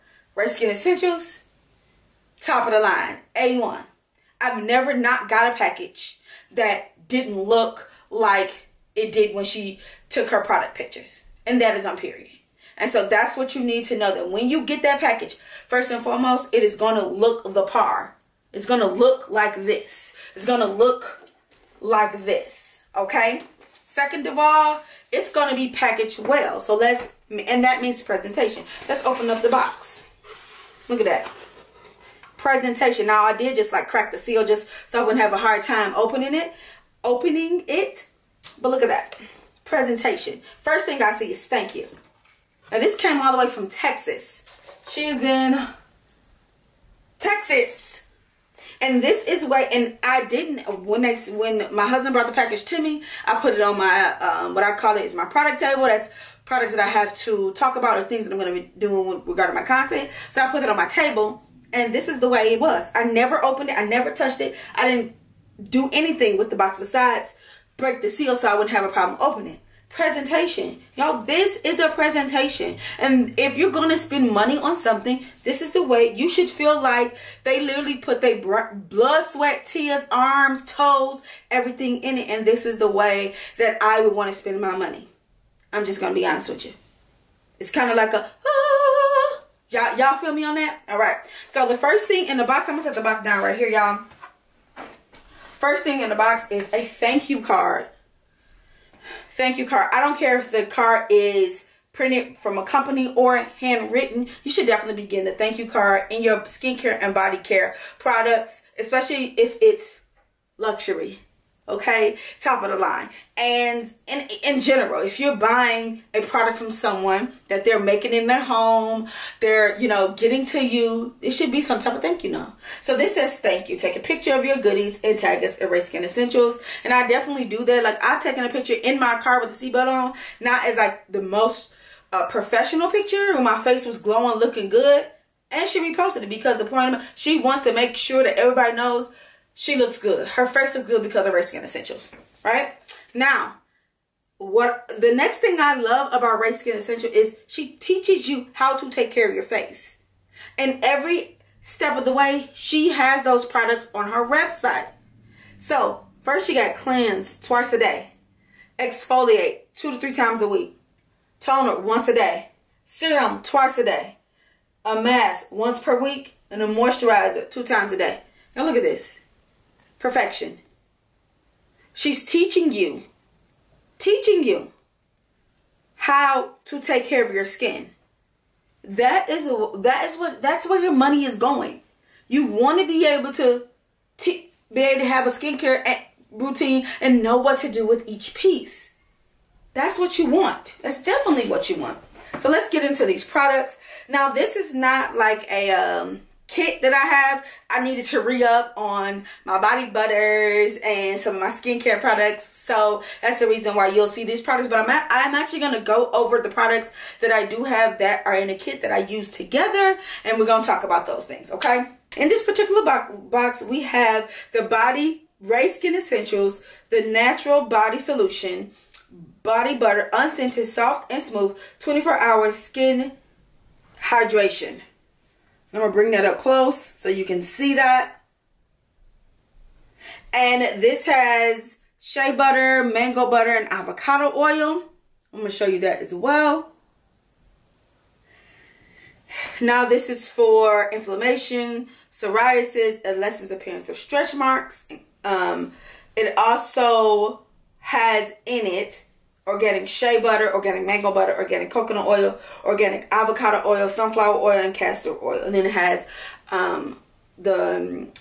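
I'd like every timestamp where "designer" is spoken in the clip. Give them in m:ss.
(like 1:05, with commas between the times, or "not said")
not said.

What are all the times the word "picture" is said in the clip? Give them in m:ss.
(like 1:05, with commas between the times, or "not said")
0:10, 2:03, 2:08, 2:12.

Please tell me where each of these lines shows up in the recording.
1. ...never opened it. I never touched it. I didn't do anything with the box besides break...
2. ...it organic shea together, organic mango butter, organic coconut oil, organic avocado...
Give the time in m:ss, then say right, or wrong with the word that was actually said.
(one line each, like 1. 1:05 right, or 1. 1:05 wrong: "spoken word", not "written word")
1. 1:03 right
2. 4:08 wrong: "butter", not "together".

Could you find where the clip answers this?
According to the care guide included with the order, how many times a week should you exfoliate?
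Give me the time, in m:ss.
2:39.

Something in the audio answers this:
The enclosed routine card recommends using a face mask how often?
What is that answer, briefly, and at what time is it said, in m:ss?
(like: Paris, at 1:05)
Once per week, at 2:45.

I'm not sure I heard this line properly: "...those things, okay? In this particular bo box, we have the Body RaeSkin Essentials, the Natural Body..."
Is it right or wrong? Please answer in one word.
right.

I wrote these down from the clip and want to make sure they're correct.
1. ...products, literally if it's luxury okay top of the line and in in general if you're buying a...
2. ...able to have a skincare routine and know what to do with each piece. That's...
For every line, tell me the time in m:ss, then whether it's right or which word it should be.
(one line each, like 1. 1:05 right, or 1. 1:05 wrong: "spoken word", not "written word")
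1. 1:47 wrong: "especially", not "literally"
2. 3:04 right.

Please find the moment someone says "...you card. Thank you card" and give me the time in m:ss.
1:37.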